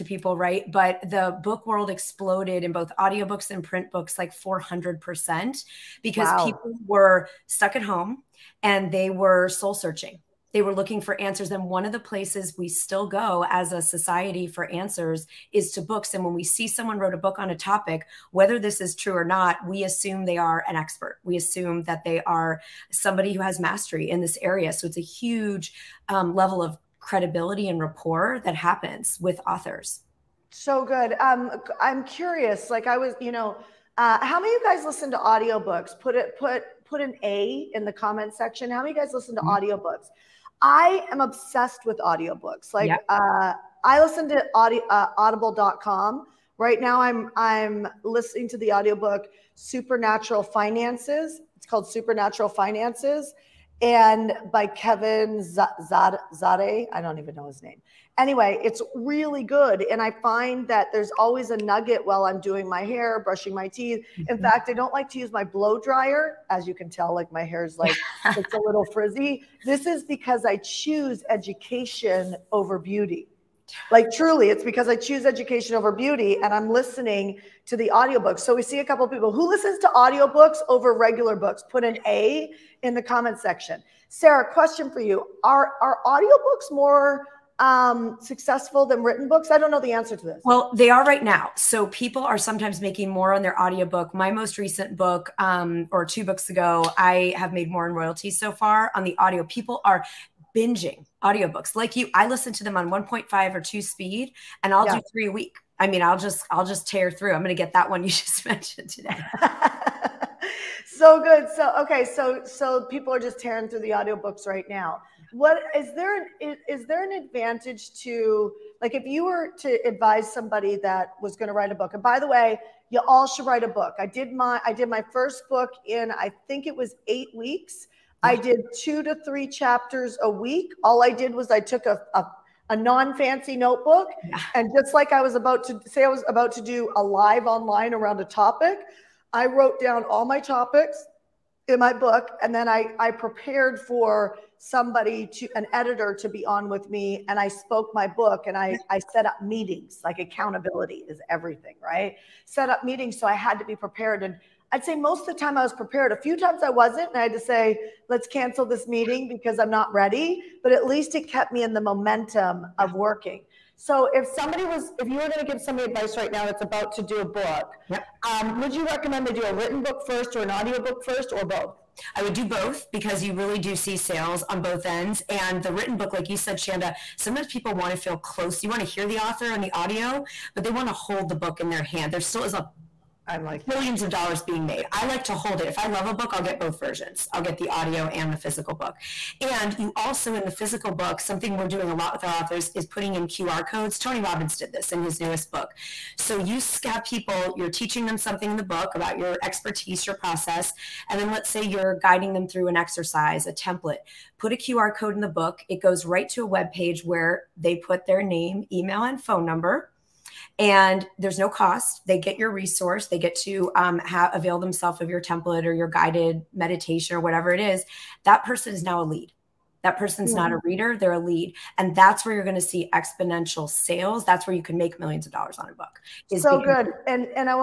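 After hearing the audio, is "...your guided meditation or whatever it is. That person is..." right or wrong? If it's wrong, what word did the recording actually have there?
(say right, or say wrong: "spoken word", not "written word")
right.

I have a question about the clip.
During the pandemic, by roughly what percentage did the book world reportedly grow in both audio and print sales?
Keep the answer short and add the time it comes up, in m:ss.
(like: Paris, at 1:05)
400%, at 0:04.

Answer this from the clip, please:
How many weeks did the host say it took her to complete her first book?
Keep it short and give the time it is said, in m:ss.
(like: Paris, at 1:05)
8, at 2:07.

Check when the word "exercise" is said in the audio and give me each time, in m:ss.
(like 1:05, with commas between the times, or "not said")
3:22.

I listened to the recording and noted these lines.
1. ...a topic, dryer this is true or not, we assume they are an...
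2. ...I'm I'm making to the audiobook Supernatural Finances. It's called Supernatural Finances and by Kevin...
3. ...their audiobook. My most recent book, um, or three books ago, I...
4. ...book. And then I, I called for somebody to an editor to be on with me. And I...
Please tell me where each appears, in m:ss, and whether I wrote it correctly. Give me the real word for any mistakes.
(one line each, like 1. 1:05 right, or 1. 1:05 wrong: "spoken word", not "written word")
1. 0:17 wrong: "whether", not "dryer"
2. 0:47 wrong: "listening", not "making"
3. 1:33 wrong: "two", not "three"
4. 2:21 wrong: "prepared", not "called".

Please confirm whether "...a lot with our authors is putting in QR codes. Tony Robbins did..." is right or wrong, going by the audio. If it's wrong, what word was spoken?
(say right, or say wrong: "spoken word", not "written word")
right.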